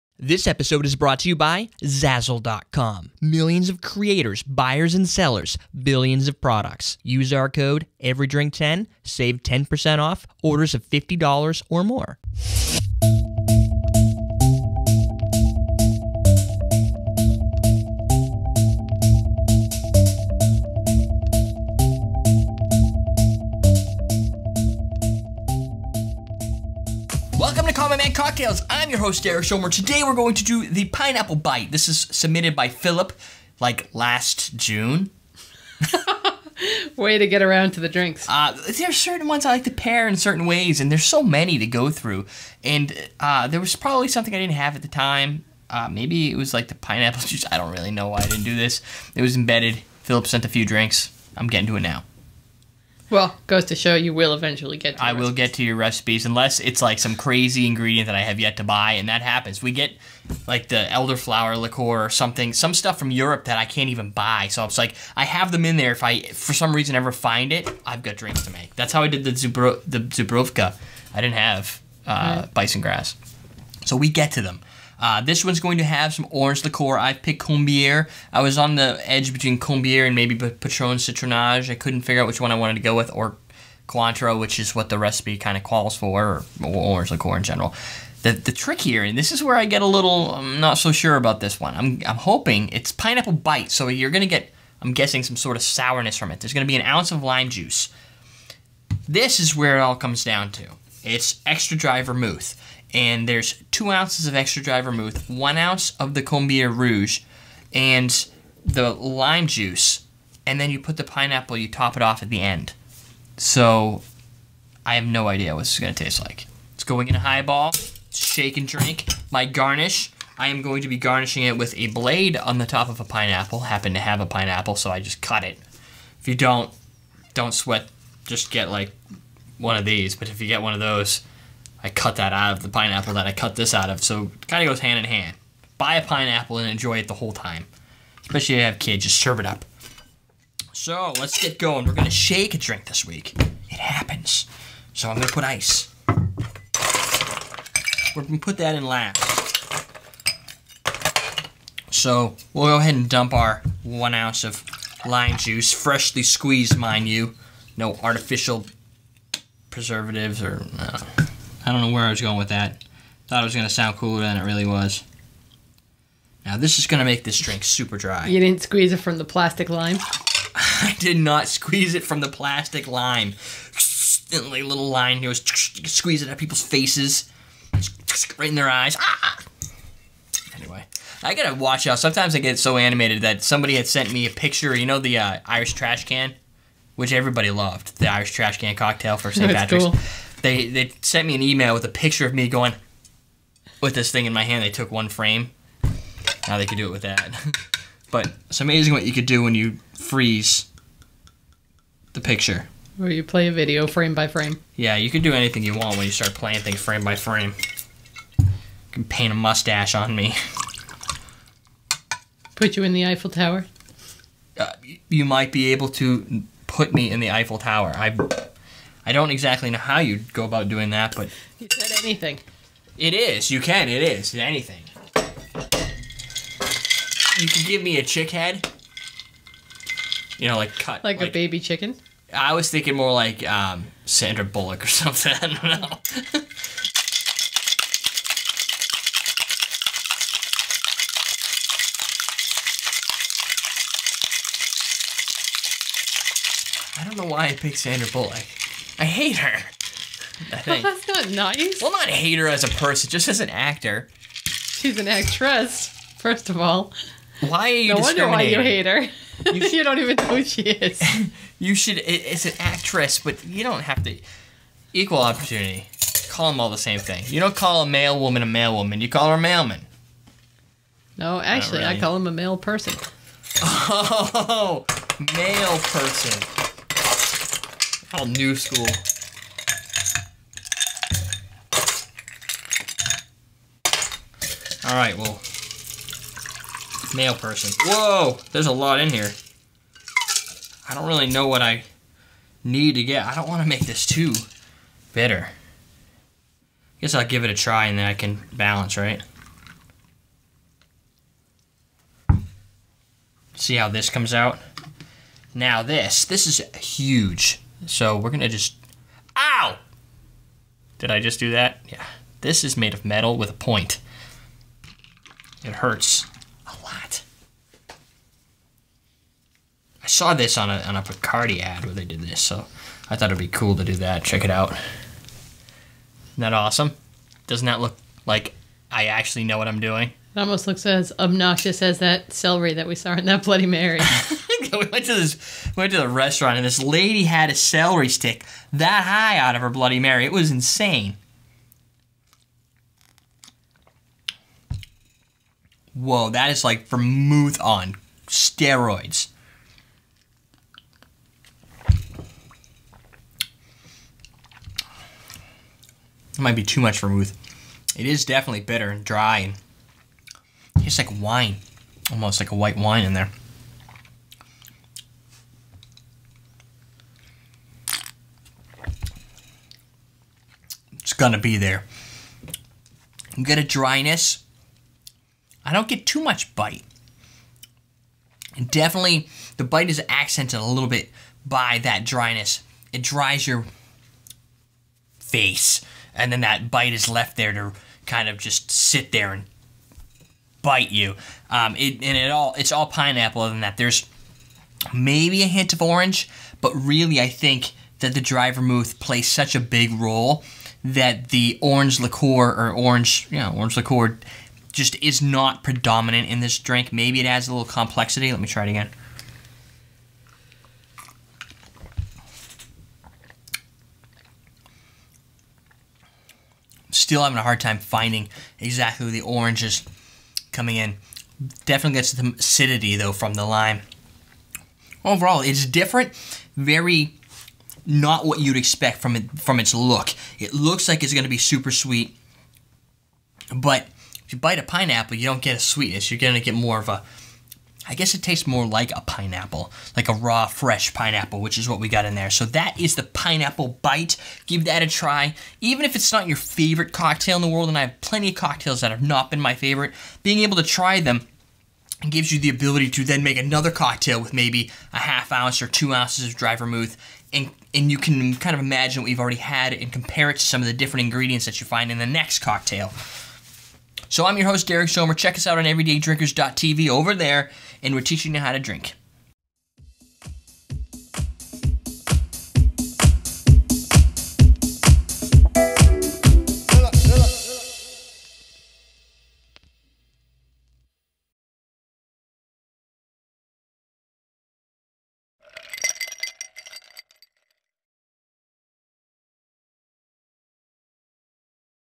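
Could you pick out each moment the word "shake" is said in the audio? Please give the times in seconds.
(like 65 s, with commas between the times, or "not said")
118 s, 142 s.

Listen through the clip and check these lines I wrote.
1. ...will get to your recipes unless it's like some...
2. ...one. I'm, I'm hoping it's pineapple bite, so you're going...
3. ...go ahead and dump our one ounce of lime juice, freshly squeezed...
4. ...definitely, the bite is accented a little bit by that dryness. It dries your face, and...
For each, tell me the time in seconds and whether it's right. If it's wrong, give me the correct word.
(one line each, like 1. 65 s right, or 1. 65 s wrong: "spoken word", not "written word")
1. 55 s right
2. 91 s right
3. 152 s right
4. 378 s right.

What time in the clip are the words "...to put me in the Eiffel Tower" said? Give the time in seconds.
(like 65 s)
215 s.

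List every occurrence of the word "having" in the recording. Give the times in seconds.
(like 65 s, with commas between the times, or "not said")
417 s.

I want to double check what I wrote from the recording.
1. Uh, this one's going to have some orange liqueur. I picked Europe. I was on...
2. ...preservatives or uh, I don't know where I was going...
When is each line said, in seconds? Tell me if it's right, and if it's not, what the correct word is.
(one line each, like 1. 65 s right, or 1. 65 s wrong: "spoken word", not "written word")
1. 75 s wrong: "Combier", not "Europe"
2. 159 s right.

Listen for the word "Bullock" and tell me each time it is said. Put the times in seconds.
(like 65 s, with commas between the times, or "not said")
234 s, 248 s.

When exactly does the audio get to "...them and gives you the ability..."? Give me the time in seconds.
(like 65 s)
451 s.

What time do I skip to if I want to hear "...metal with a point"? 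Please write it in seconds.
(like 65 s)
313 s.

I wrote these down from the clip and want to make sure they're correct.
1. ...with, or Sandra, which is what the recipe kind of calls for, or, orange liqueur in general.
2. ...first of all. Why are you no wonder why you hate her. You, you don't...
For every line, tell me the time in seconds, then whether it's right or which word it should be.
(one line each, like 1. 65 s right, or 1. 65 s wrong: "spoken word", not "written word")
1. 82 s wrong: "Cointreau", not "Sandra"
2. 256 s right.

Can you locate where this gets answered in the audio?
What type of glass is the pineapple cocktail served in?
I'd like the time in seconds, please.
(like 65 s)
117 s.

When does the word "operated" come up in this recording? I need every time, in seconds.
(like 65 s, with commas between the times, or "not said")
not said.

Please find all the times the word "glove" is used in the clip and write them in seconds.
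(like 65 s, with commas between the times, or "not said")
not said.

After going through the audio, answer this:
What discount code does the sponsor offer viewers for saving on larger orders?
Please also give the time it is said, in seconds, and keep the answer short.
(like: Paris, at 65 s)
EveryDrink10, at 8 s.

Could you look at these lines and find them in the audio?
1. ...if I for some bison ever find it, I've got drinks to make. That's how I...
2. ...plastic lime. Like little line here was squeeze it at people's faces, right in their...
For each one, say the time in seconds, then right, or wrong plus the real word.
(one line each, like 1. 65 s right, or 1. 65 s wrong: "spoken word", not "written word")
1. 65 s wrong: "reason", not "bison"
2. 172 s right.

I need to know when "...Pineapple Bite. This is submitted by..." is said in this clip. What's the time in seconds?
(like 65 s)
30 s.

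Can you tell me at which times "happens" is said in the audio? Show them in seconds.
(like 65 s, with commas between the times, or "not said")
59 s, 123 s, 143 s.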